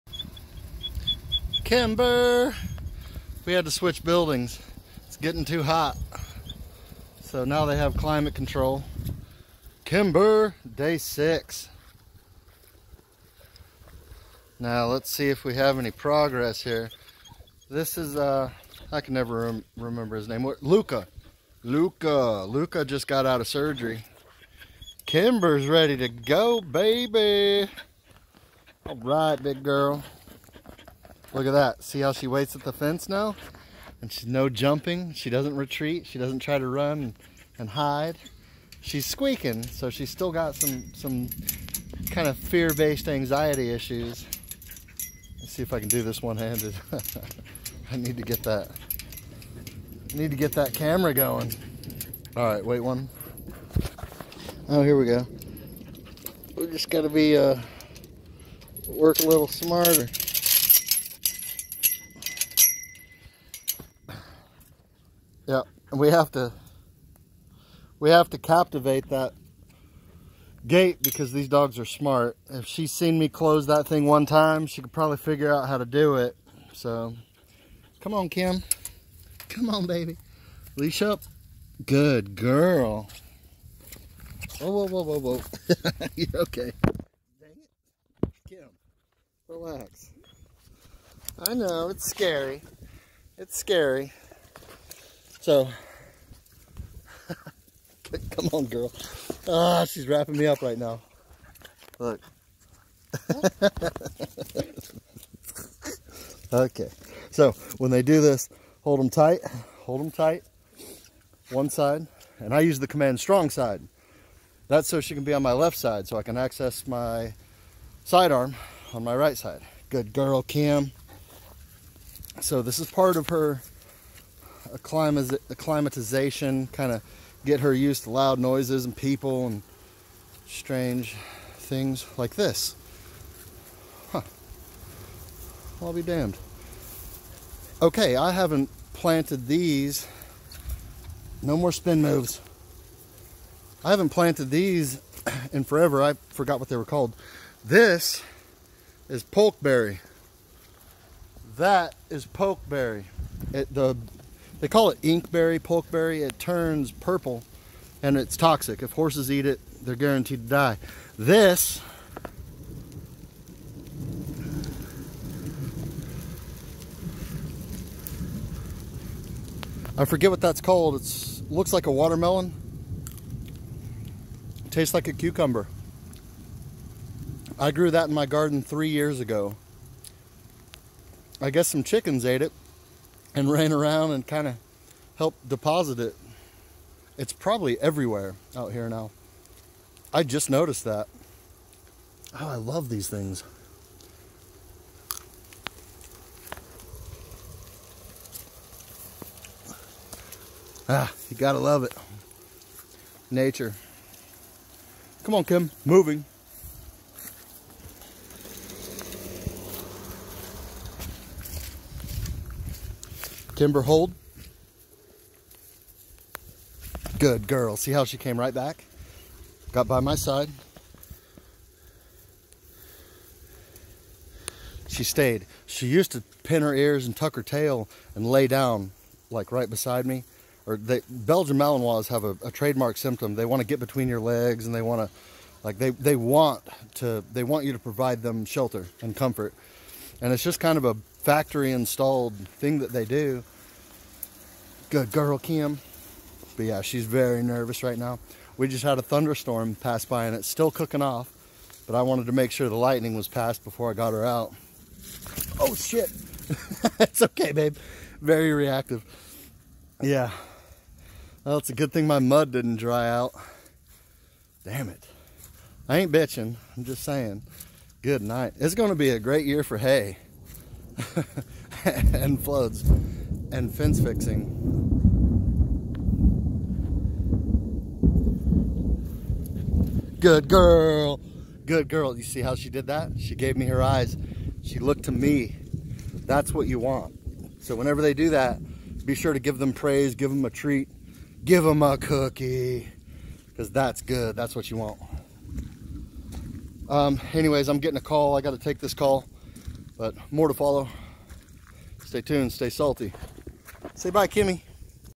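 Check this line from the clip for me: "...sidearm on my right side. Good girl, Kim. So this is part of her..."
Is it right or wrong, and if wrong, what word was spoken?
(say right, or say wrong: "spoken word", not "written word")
right.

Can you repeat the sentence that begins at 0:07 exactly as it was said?
So now they have climate control.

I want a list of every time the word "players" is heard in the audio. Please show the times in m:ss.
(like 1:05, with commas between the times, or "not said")
not said.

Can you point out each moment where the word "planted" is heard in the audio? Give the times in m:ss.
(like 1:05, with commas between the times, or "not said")
2:18, 2:24.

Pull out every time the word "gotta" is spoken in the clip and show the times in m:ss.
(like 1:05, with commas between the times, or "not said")
0:56, 3:21.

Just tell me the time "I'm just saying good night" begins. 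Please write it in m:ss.
4:26.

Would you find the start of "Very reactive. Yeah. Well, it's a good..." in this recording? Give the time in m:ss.
4:18.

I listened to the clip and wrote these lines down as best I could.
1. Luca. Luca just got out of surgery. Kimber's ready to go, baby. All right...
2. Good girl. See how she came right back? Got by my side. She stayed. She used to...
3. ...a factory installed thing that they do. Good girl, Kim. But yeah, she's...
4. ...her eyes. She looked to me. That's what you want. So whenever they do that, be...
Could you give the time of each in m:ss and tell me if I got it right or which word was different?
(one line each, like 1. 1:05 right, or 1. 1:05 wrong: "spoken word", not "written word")
1. 0:21 right
2. 3:37 right
3. 4:00 right
4. 4:43 right.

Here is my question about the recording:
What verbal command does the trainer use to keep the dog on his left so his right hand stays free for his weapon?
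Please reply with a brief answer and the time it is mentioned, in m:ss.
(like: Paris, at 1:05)
strong side, at 1:53.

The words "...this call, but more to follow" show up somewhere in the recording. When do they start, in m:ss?
4:58.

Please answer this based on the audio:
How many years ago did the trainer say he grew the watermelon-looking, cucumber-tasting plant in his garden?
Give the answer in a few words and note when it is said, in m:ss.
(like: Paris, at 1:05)
3, at 2:58.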